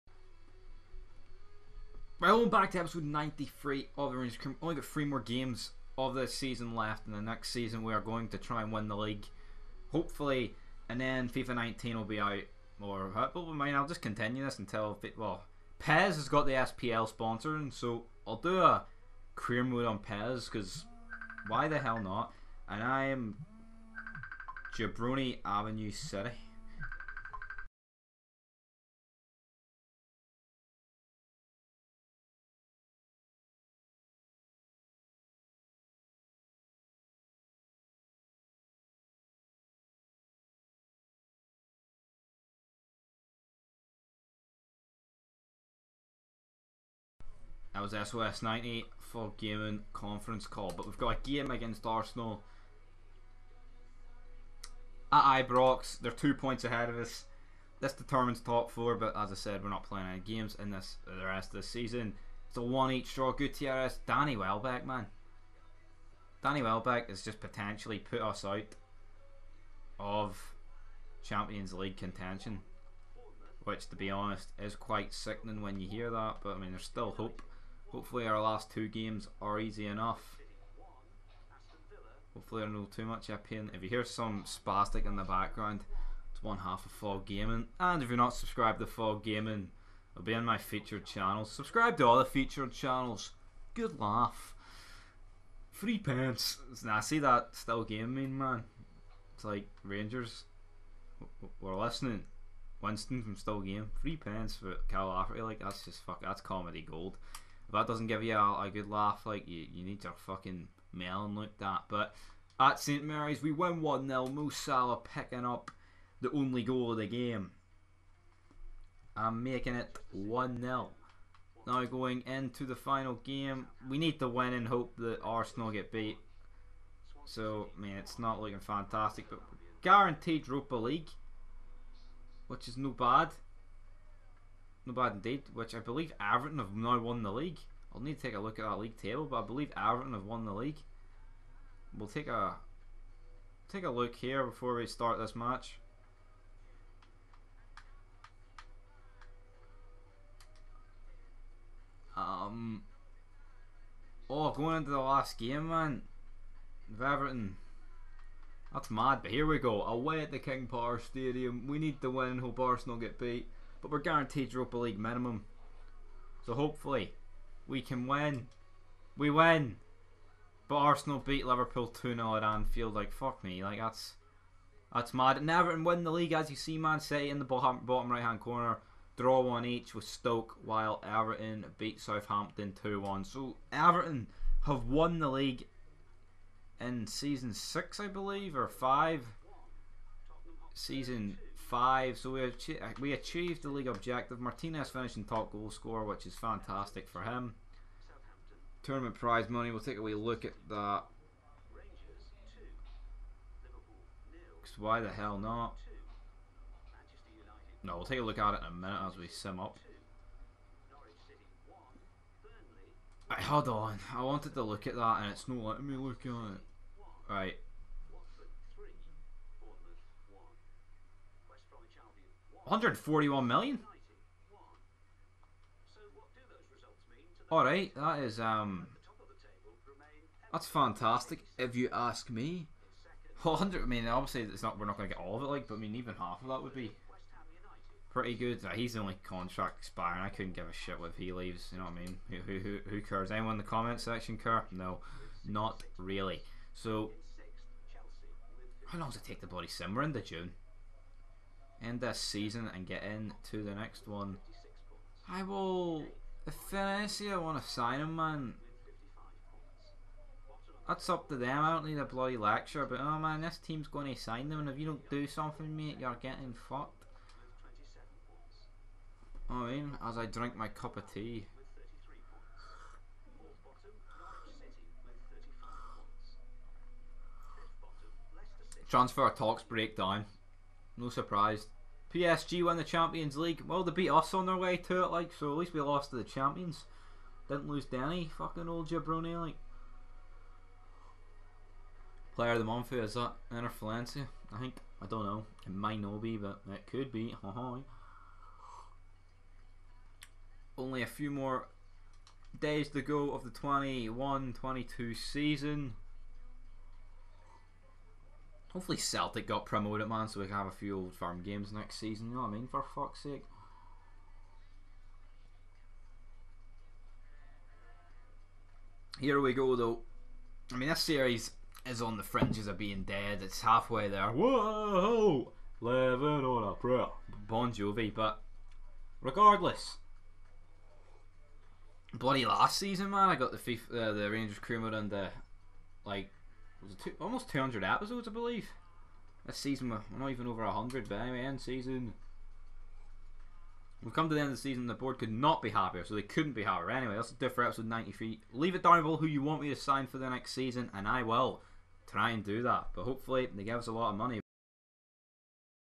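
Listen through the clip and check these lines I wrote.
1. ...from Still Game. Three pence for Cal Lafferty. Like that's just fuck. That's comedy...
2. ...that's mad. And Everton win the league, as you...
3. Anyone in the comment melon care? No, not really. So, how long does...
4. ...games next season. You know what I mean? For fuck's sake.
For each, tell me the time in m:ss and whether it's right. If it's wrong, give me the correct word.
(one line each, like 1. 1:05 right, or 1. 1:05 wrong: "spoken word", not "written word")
1. 1:43 right
2. 2:54 right
3. 4:03 wrong: "section", not "melon"
4. 5:11 right.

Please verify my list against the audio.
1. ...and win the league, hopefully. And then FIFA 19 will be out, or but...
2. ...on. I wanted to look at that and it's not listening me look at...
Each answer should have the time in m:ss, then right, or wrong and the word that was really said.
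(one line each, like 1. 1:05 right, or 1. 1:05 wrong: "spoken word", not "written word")
1. 0:08 right
2. 3:33 wrong: "letting", not "listening".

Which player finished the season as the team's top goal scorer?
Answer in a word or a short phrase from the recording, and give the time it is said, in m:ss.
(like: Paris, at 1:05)
Martinez, at 3:14.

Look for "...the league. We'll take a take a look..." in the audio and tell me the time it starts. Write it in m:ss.
2:20.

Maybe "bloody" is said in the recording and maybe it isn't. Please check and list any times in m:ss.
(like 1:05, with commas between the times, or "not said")
4:09, 4:22, 5:32.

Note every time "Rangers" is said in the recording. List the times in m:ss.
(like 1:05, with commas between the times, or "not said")
0:04, 1:39, 5:34.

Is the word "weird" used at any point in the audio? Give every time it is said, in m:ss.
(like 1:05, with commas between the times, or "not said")
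not said.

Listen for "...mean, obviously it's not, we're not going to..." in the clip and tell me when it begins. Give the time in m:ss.
3:53.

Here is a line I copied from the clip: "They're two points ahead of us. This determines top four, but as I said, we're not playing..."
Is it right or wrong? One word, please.
right.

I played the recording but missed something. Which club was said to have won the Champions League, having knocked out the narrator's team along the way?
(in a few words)
PSG.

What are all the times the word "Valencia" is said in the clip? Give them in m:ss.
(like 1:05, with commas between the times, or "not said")
4:16, 4:53.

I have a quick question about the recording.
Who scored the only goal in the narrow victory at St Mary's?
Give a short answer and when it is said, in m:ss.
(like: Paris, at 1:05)
Mo Salah, at 1:54.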